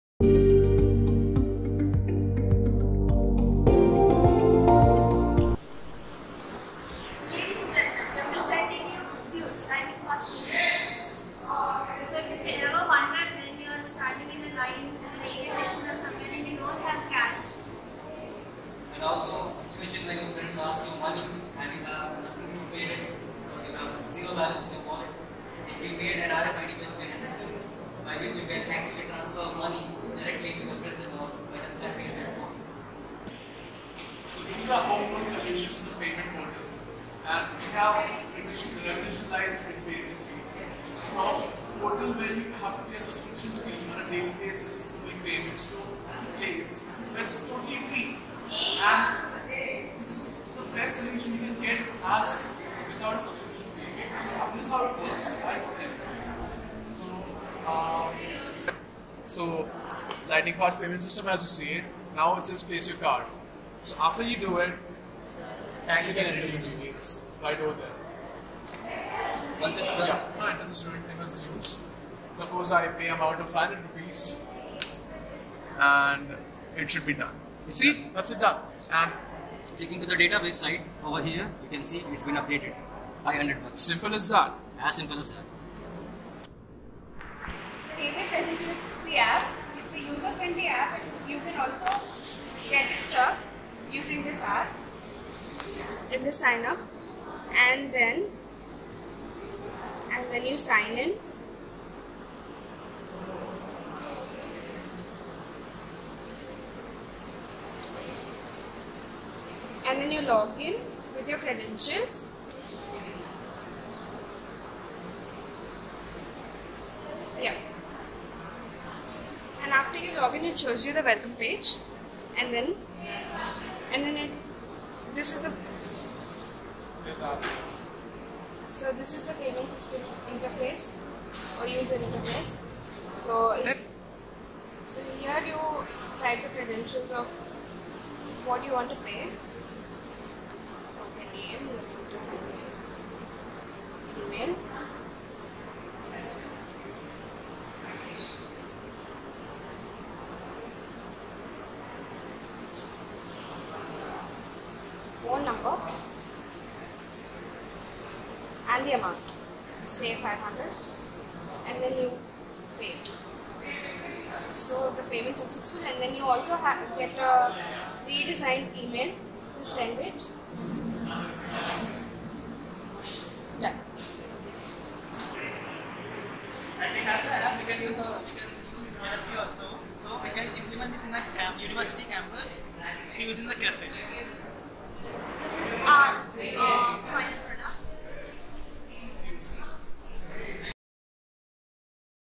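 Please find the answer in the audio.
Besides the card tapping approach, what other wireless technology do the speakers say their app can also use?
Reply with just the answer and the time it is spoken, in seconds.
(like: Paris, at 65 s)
NFC, at 178 s.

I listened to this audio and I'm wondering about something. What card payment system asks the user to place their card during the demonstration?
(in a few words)
Lightning Card.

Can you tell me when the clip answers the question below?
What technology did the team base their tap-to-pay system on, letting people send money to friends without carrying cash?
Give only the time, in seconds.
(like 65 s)
26 s.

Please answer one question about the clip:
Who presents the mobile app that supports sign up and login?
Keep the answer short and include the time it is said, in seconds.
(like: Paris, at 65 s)
David, at 87 s.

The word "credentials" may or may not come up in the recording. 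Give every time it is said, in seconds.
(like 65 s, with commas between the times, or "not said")
111 s, 136 s.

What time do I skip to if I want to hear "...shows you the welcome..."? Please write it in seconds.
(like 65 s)
120 s.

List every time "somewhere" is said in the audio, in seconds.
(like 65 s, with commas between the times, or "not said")
15 s.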